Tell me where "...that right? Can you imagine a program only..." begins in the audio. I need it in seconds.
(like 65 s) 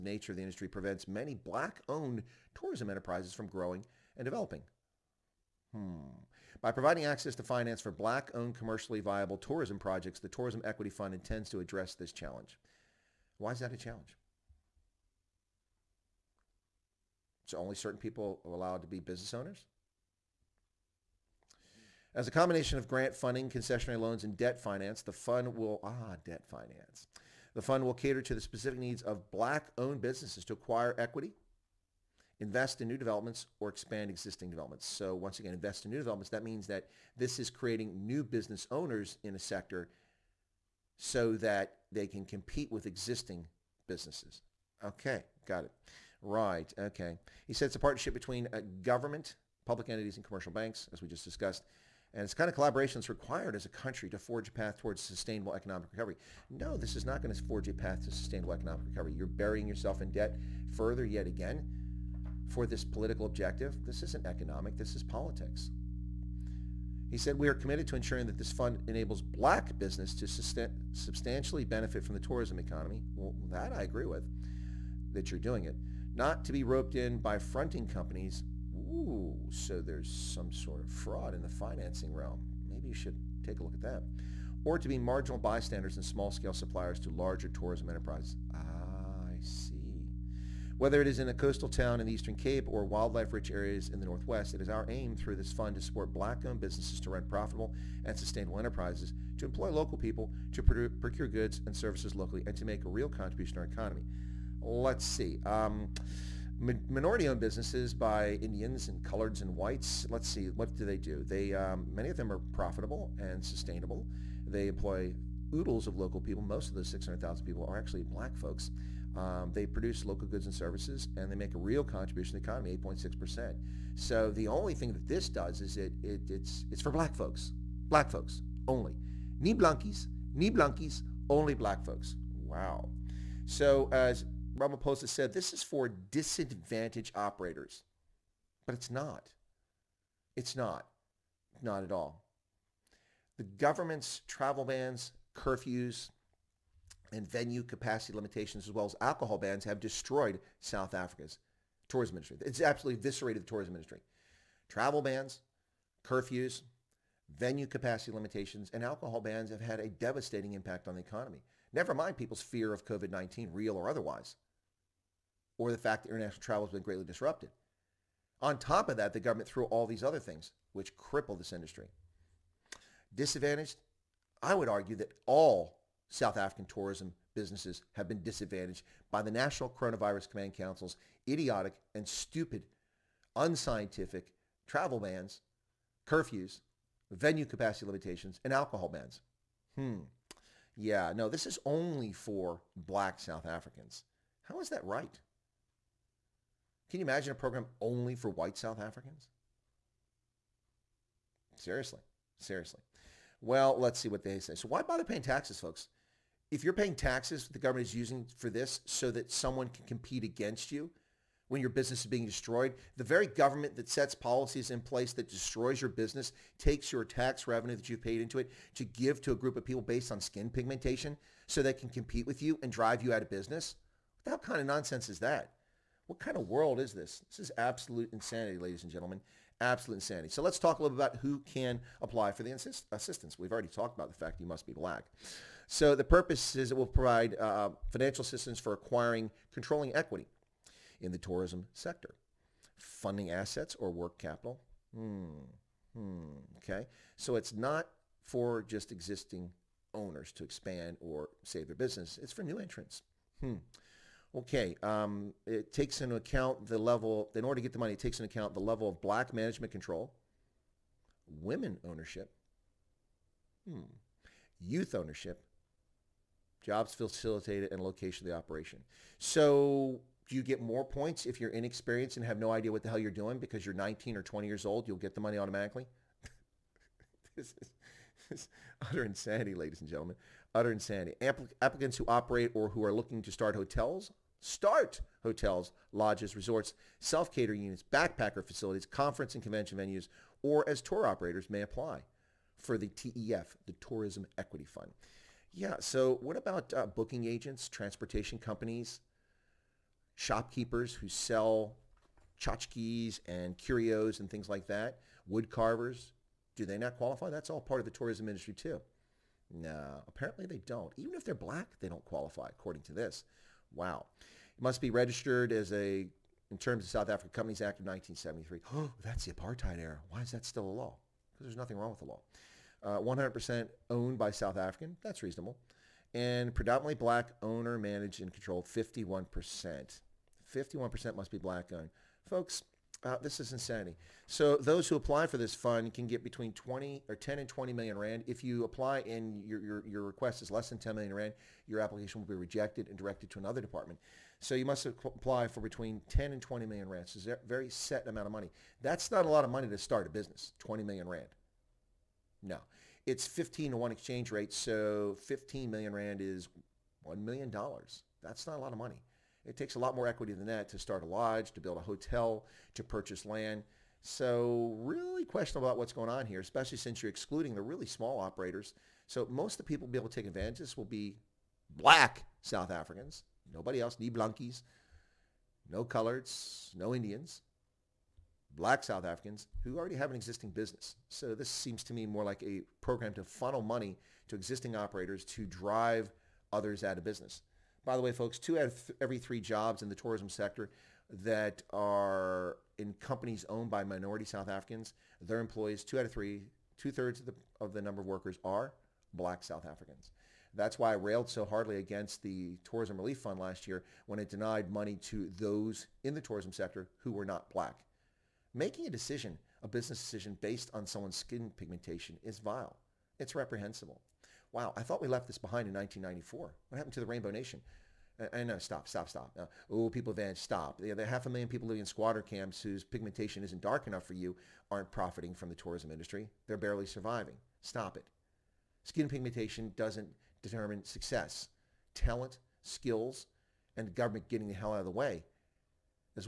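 194 s.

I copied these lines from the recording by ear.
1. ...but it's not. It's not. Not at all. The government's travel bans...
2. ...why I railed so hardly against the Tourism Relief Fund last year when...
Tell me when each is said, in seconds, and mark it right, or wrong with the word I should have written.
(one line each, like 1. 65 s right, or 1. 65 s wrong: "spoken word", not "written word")
1. 138 s right
2. 400 s right.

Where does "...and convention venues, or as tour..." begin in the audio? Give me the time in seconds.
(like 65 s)
289 s.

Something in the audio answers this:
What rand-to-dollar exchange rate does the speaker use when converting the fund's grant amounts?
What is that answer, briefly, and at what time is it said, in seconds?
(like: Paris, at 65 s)
15 to 1, at 353 s.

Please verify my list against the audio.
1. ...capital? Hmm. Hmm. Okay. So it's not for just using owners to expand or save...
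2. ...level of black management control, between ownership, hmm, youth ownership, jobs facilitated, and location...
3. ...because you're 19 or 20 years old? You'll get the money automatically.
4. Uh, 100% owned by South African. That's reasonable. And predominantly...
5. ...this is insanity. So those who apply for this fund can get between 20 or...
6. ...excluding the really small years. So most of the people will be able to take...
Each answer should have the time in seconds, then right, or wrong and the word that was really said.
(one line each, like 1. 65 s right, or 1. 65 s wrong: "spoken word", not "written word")
1. 244 s wrong: "existing", not "using"
2. 258 s wrong: "women", not "between"
3. 273 s right
4. 322 s right
5. 333 s right
6. 367 s wrong: "operators", not "years".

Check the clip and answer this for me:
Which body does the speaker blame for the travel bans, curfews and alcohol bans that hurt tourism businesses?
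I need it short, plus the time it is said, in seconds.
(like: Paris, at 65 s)
National Coronavirus Command Council, at 179 s.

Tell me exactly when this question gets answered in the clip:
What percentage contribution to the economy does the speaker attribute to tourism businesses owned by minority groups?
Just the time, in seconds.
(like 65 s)
122 s.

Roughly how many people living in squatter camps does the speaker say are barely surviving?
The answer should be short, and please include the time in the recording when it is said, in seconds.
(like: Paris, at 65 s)
half a million, at 421 s.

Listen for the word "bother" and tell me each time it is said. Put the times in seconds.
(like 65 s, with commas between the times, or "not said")
204 s.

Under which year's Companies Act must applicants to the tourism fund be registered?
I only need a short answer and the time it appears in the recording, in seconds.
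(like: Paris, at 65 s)
1973, at 317 s.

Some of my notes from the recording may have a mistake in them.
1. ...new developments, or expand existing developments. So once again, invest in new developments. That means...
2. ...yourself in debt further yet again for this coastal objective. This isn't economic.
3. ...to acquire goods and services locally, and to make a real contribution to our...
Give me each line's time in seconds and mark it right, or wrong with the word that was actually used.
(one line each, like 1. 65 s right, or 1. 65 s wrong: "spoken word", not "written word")
1. 32 s right
2. 59 s wrong: "political", not "coastal"
3. 100 s wrong: "procure", not "acquire".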